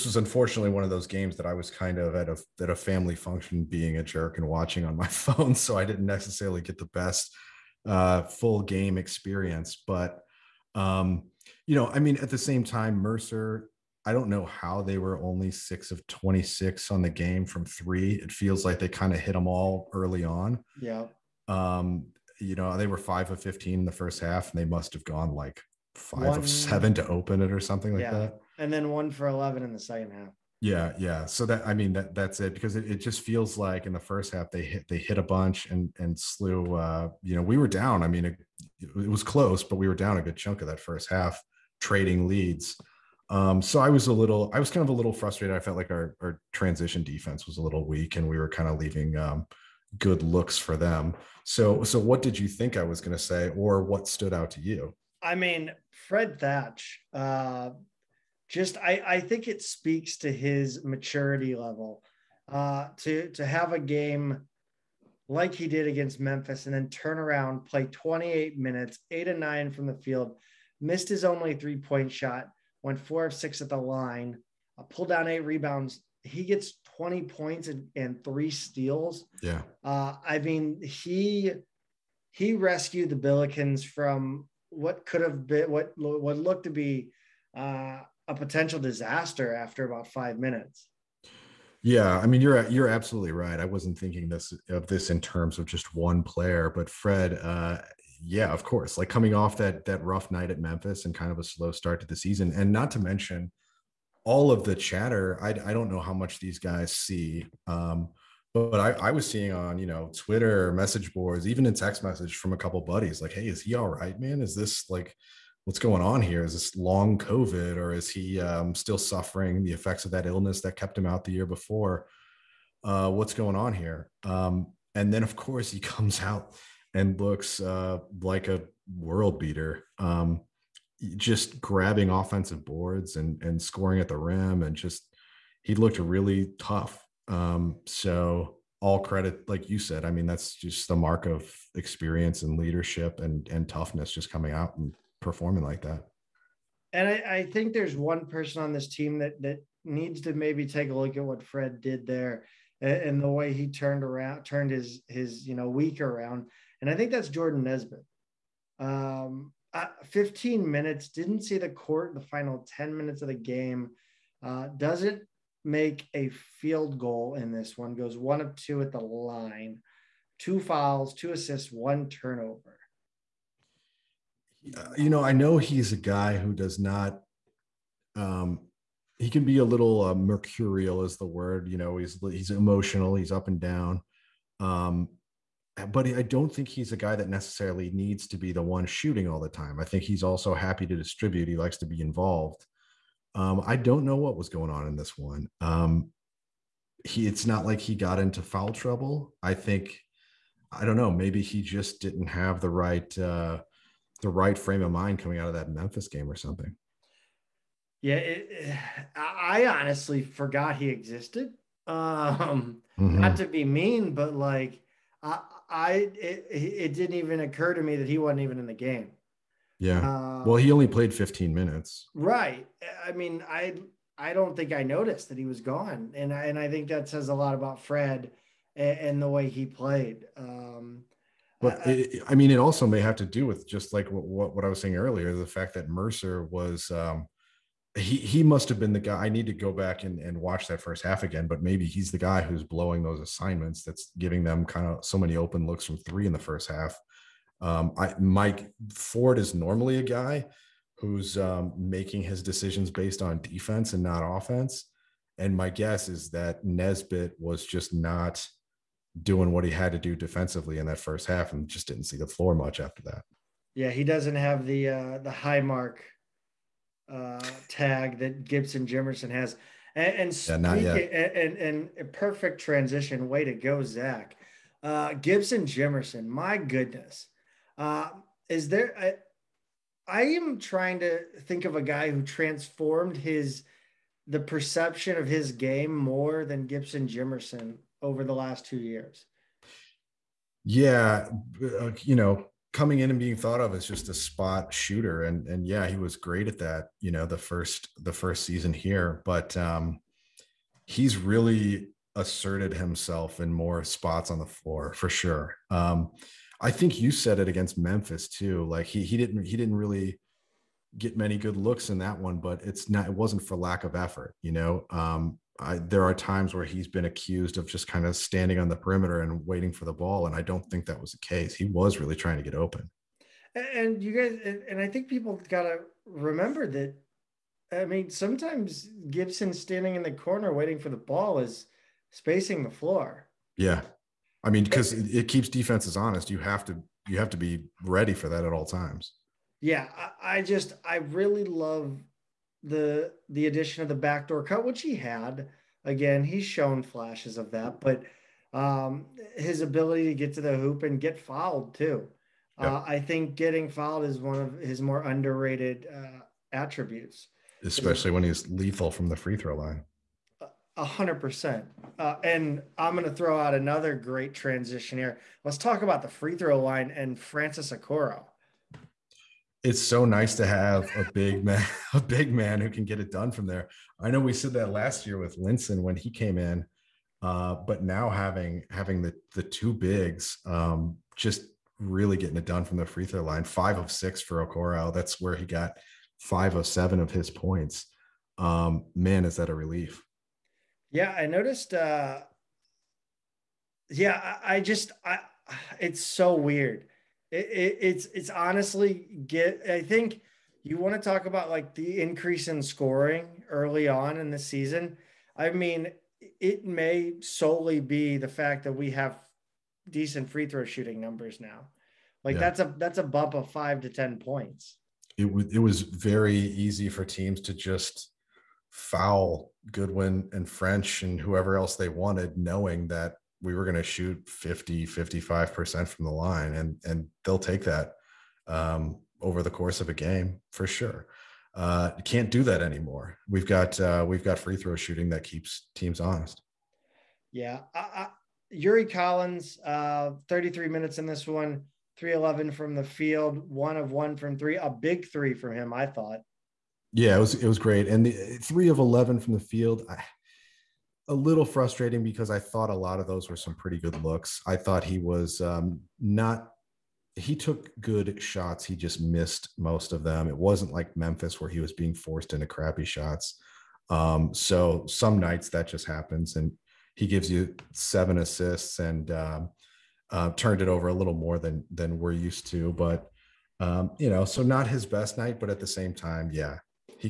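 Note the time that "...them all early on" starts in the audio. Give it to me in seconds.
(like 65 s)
19 s.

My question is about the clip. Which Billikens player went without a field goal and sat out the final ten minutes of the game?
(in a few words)
Jordan Nesbitt.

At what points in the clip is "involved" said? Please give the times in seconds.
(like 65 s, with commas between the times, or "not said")
192 s.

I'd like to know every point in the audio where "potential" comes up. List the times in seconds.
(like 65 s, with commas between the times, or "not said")
88 s.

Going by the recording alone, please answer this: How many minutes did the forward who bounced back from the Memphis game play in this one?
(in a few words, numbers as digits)
28.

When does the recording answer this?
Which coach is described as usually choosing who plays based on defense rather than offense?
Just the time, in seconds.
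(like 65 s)
248 s.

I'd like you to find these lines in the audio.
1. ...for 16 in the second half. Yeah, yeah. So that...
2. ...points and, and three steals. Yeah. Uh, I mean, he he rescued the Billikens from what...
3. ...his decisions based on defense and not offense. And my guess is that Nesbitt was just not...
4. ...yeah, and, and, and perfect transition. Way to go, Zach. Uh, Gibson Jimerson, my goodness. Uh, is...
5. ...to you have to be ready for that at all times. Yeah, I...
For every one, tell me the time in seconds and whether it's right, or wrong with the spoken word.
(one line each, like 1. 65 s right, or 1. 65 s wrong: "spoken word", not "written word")
1. 29 s wrong: "11", not "16"
2. 77 s right
3. 252 s right
4. 270 s right
5. 336 s right.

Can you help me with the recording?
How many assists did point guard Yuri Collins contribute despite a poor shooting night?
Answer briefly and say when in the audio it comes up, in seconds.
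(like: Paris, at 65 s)
7, at 467 s.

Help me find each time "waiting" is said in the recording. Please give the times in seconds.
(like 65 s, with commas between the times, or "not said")
319 s, 330 s.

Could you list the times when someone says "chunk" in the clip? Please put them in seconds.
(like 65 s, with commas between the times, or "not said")
40 s.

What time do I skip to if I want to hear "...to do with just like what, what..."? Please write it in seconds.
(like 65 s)
233 s.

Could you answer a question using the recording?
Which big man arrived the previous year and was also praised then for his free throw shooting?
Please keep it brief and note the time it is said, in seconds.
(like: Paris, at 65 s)
Linssen, at 375 s.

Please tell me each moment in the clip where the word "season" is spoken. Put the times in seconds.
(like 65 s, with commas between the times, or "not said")
102 s, 298 s, 404 s.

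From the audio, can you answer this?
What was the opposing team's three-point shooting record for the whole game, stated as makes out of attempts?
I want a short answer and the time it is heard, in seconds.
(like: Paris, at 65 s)
6 of 26, at 15 s.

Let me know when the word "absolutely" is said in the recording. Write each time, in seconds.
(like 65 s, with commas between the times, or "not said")
92 s.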